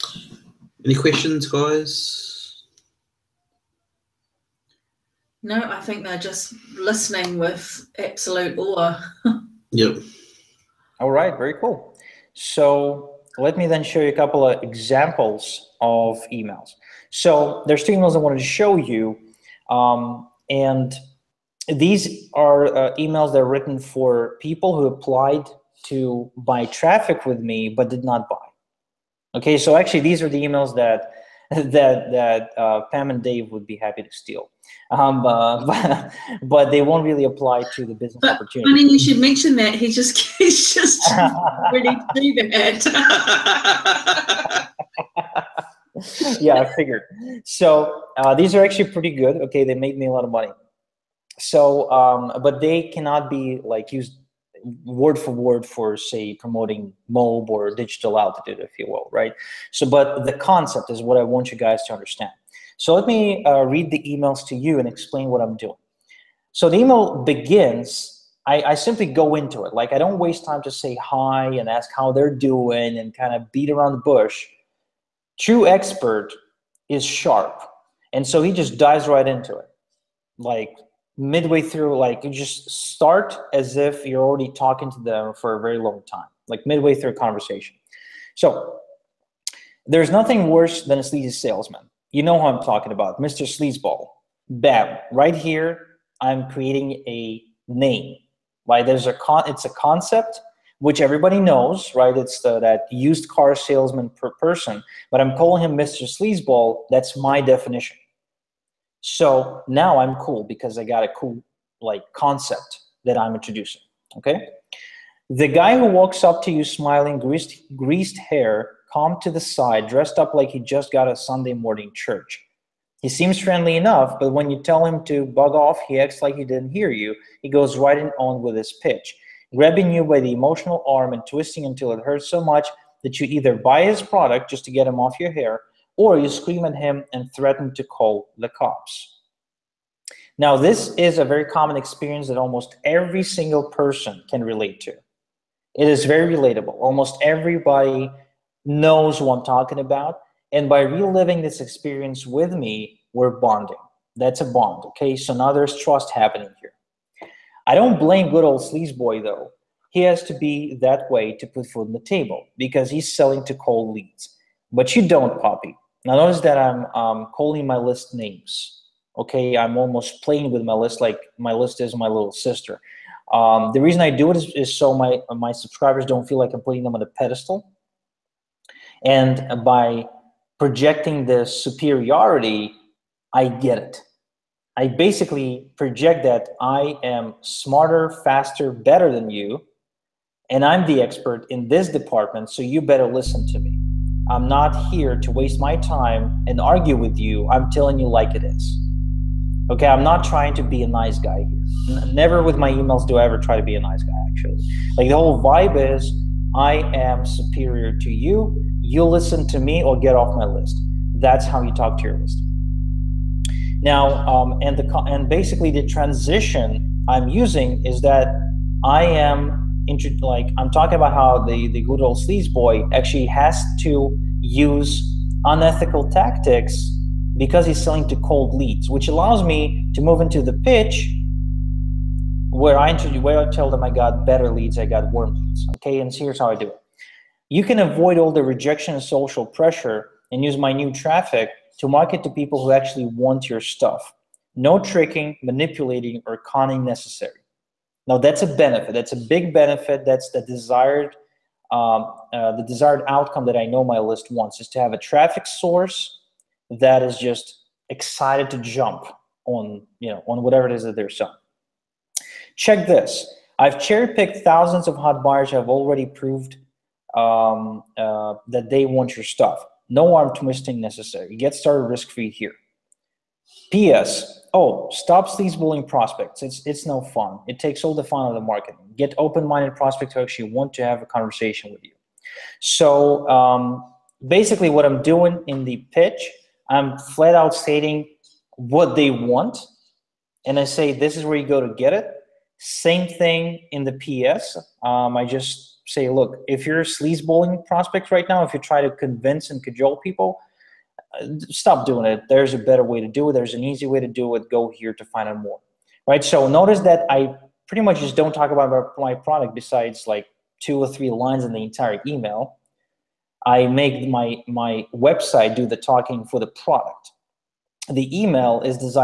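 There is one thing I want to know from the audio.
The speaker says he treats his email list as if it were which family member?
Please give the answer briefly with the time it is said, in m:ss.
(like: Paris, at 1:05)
little sister, at 2:52.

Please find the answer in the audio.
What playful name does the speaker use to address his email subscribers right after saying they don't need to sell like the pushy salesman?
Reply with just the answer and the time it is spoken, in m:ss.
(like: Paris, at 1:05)
Poppy, at 2:45.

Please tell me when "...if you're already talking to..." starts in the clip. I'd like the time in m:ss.
1:23.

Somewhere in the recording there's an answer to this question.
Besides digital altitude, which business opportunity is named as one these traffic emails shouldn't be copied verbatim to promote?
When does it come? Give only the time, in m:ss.
0:57.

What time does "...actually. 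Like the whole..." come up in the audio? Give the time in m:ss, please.
3:24.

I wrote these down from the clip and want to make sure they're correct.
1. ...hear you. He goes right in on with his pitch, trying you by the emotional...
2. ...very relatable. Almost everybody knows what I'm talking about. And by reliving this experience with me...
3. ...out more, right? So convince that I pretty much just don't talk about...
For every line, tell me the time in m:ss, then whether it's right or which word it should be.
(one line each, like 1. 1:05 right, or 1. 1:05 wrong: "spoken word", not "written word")
1. 2:06 wrong: "grabbing", not "trying"
2. 2:26 right
3. 5:05 wrong: "notice", not "convince".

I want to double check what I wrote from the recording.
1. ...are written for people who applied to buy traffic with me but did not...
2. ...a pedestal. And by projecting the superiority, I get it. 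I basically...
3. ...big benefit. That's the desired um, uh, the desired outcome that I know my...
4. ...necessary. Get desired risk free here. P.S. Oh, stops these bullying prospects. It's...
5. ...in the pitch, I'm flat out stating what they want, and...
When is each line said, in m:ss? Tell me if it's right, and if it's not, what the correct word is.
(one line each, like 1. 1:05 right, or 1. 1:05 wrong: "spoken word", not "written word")
1. 0:23 right
2. 2:57 right
3. 4:09 right
4. 4:30 wrong: "started", not "desired"
5. 4:45 right.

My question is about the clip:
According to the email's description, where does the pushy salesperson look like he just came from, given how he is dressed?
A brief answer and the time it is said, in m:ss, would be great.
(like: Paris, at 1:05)
Sunday morning church, at 2:01.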